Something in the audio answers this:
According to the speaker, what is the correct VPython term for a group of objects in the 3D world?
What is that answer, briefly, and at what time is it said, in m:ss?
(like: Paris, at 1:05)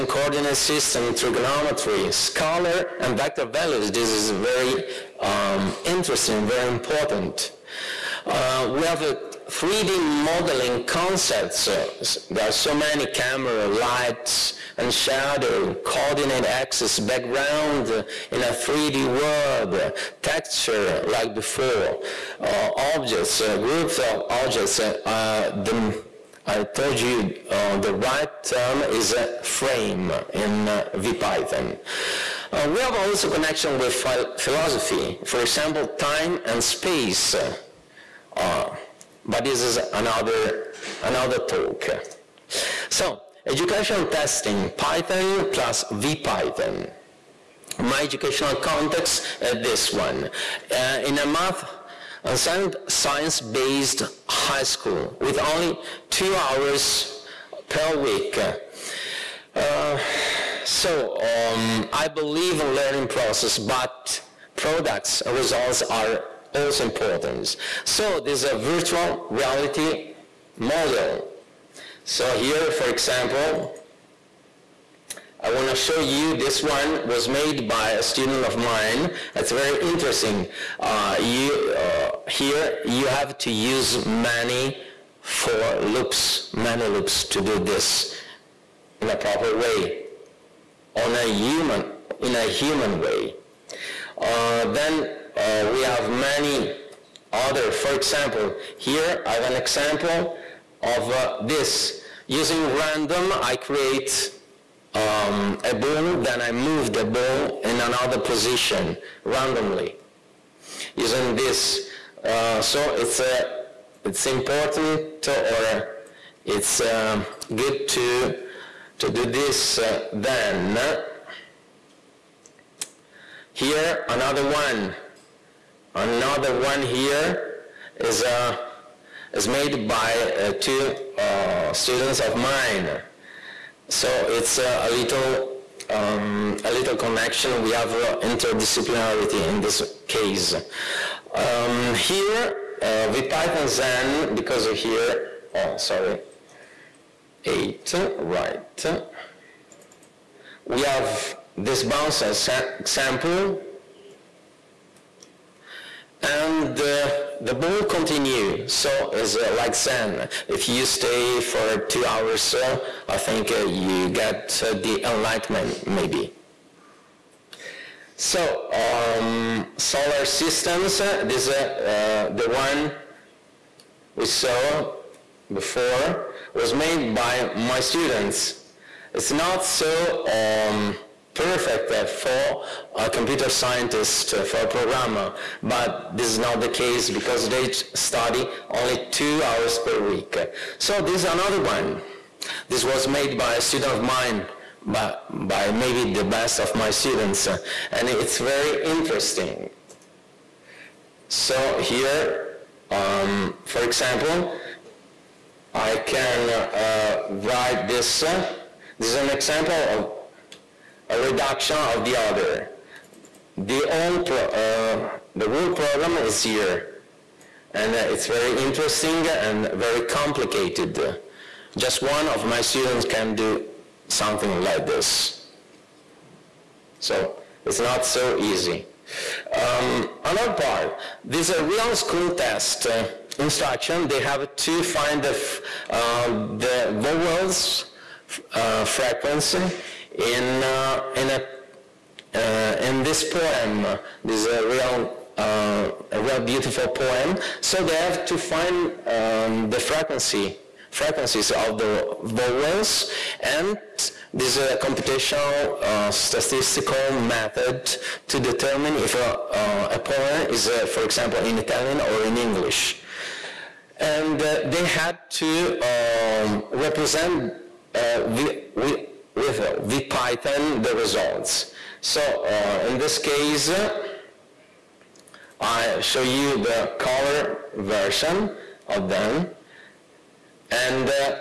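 frame, at 0:29.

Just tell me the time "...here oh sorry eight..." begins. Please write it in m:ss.
2:24.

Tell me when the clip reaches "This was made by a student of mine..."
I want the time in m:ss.
3:12.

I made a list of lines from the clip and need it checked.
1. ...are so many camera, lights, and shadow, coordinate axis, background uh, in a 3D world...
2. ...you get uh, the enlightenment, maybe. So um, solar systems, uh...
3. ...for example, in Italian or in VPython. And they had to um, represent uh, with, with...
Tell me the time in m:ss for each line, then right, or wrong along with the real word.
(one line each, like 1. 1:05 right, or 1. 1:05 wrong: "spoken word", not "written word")
1. 0:12 right
2. 2:43 right
3. 4:20 wrong: "English", not "VPython".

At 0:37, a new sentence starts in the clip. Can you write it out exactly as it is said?
Uh, but this is another, another talk.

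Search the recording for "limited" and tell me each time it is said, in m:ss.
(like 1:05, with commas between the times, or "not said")
not said.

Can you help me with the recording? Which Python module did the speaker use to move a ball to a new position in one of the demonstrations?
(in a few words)
random.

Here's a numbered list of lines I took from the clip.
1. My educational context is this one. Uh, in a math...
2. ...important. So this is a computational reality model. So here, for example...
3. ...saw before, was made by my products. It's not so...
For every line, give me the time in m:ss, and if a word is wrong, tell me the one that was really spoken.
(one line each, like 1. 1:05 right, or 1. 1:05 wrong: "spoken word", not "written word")
1. 0:47 right
2. 1:06 wrong: "virtual", not "computational"
3. 2:54 wrong: "students", not "products".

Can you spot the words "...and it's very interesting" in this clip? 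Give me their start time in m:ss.
3:17.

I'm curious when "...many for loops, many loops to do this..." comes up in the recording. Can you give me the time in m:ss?
1:24.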